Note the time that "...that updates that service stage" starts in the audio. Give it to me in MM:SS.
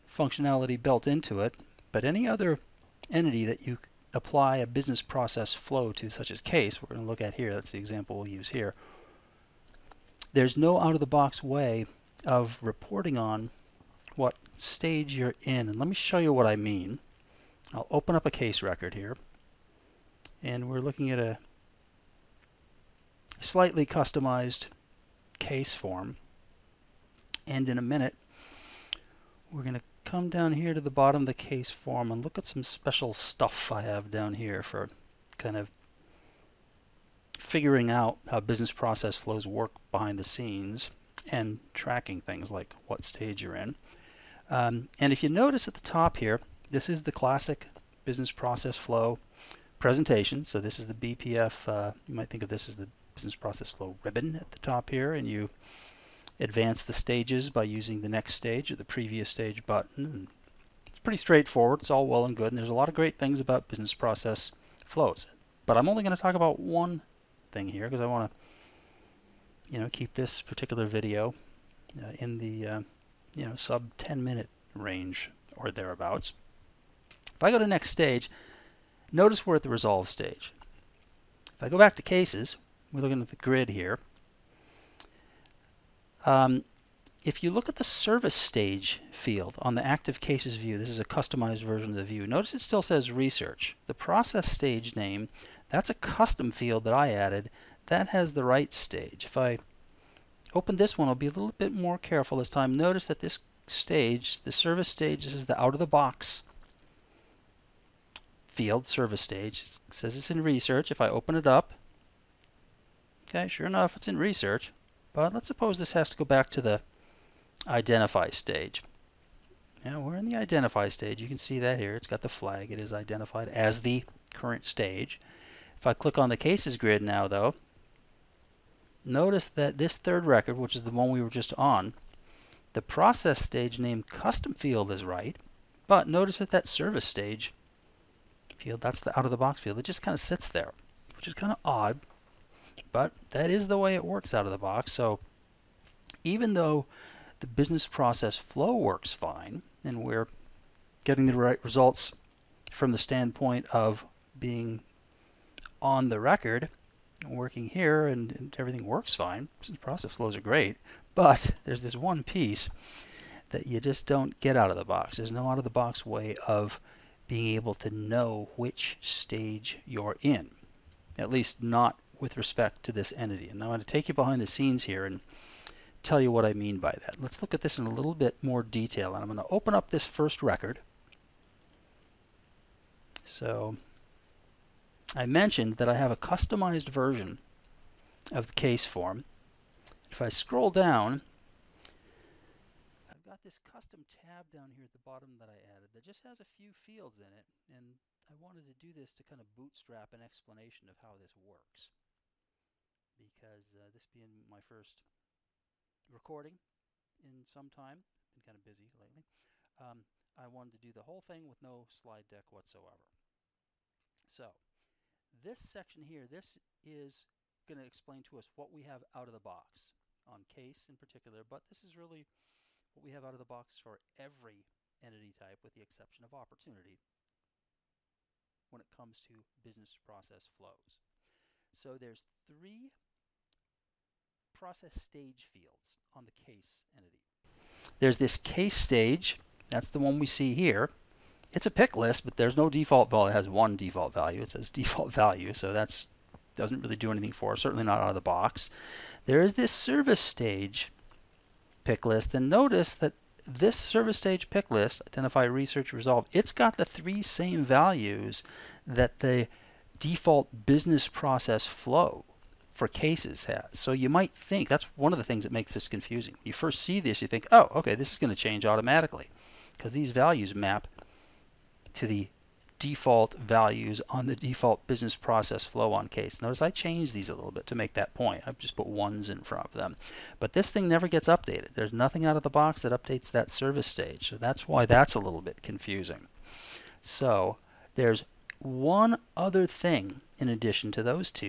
04:42.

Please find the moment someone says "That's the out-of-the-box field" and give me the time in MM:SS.
02:18.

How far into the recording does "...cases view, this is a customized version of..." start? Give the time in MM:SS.
01:30.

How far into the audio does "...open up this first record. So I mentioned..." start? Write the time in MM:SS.
02:59.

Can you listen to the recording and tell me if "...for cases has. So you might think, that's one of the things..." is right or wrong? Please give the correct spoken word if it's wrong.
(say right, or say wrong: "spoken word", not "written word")
right.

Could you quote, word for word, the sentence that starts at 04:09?
There is this service stage pick list.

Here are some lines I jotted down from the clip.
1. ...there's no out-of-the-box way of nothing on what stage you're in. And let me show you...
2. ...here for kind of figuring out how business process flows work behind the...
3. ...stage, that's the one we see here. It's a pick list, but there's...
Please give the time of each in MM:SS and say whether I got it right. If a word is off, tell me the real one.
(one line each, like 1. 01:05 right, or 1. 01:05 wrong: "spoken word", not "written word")
1. 00:10 wrong: "reporting", not "nothing"
2. 00:34 right
3. 03:58 right.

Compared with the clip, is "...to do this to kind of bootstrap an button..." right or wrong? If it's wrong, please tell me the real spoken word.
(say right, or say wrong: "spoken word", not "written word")
wrong: "explanation", not "button".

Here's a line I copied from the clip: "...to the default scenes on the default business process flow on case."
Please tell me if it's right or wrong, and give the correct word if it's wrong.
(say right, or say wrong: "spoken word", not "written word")
wrong: "values", not "scenes".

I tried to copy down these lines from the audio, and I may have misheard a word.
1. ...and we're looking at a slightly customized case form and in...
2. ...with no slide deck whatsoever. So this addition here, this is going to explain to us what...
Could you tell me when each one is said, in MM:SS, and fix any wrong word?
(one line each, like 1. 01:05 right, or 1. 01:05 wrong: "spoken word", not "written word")
1. 00:20 right
2. 03:31 wrong: "section", not "addition".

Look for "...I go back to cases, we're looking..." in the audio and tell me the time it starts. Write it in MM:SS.
01:21.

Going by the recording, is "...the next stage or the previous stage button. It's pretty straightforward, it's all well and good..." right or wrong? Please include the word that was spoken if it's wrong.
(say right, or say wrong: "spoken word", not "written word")
right.